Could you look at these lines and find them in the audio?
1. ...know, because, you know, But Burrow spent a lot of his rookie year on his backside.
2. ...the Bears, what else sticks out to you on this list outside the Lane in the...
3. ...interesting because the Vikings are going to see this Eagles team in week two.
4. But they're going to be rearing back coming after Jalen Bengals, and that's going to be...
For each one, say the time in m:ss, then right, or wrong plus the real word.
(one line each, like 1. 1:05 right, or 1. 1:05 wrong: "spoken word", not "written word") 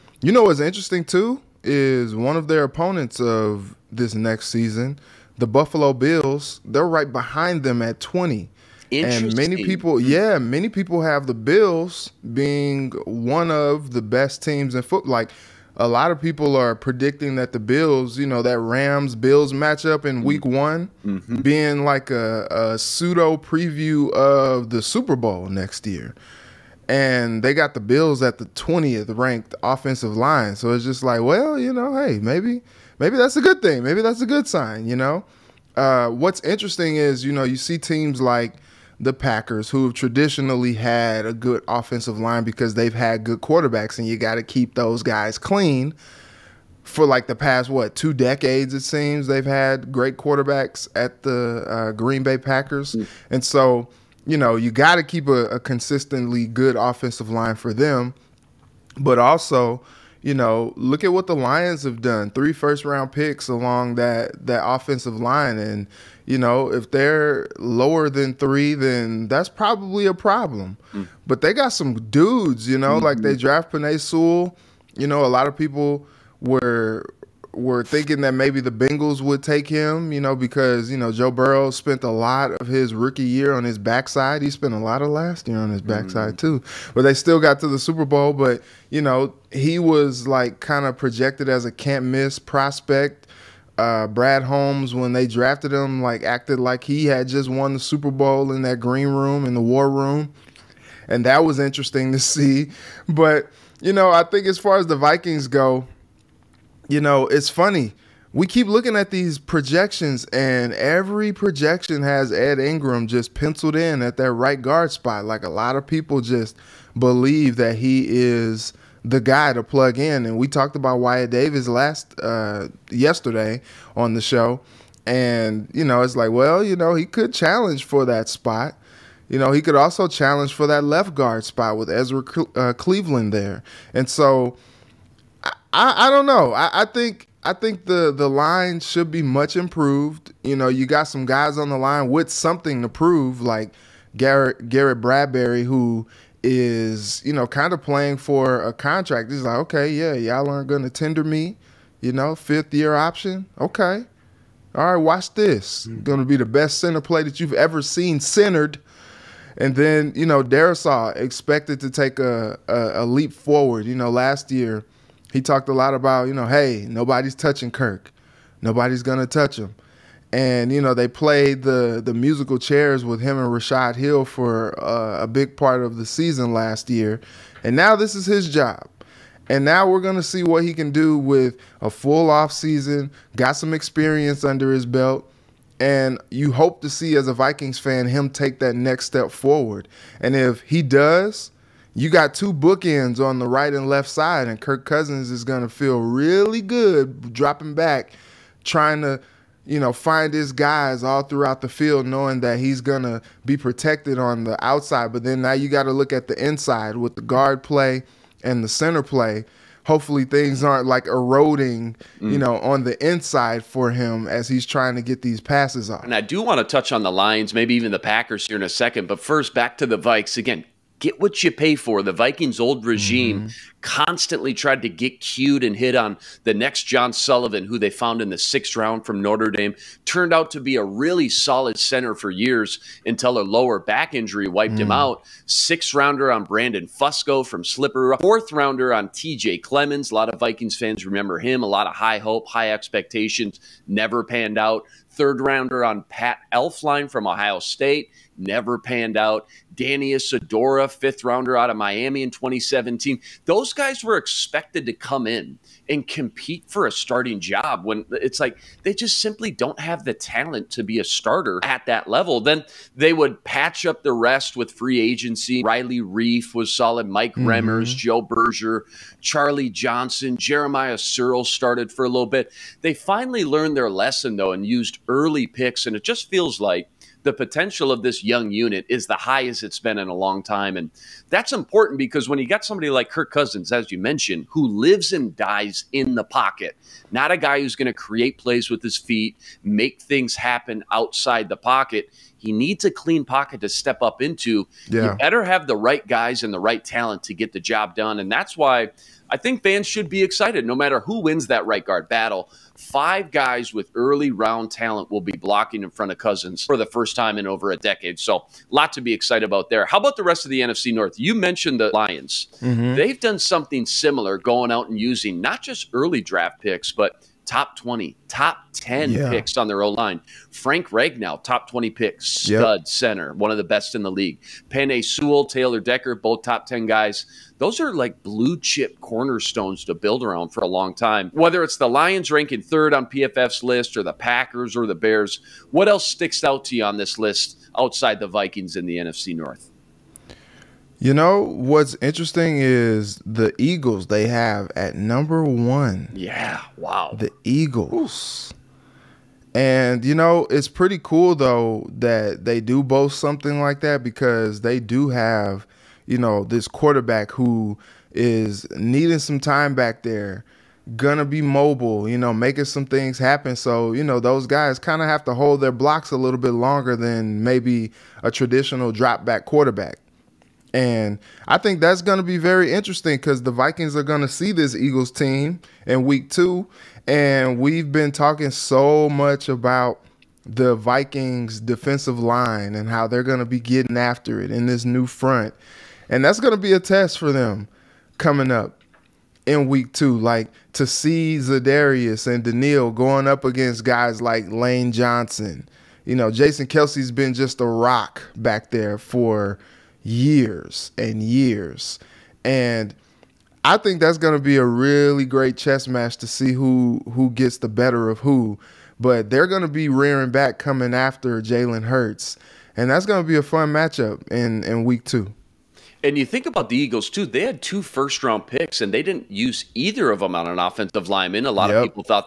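1. 1:20 wrong: "Joe", not "But"
2. 5:34 wrong: "Vikings", not "Lane"
3. 6:12 right
4. 6:48 wrong: "Hurts", not "Bengals".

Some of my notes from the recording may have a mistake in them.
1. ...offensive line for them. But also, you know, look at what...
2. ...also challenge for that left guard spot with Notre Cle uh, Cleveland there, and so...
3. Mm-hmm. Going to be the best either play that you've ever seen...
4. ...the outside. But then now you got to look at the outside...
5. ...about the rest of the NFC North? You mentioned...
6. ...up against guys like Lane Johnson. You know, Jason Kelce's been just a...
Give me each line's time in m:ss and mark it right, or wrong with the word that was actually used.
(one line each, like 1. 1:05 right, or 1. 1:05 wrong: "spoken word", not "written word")
1. 0:56 right
2. 2:09 wrong: "Ezra", not "Notre"
3. 2:35 wrong: "center", not "either"
4. 3:24 wrong: "inside", not "outside"
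5. 5:09 right
6. 6:33 right.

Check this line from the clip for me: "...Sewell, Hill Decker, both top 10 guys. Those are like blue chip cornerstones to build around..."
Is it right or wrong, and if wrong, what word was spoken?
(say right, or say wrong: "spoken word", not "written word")
wrong: "Taylor", not "Hill".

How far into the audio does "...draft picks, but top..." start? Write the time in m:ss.
5:16.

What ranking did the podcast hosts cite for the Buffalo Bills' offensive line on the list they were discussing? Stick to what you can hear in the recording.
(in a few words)
20th.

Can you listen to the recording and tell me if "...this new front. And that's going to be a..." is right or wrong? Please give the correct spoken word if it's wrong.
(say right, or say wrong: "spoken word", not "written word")
right.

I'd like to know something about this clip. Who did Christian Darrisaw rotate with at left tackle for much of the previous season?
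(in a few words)
Rashad Hill.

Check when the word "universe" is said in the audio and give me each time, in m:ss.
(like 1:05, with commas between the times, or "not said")
not said.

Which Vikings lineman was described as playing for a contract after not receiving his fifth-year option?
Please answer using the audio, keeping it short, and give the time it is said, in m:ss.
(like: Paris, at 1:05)
Garrett Bradbury, at 2:24.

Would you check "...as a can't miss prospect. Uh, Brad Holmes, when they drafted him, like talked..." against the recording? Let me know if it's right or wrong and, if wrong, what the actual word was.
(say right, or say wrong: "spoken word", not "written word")
wrong: "acted", not "talked".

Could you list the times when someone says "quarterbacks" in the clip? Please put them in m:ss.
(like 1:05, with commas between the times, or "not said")
0:43, 0:50, 5:56, 6:09.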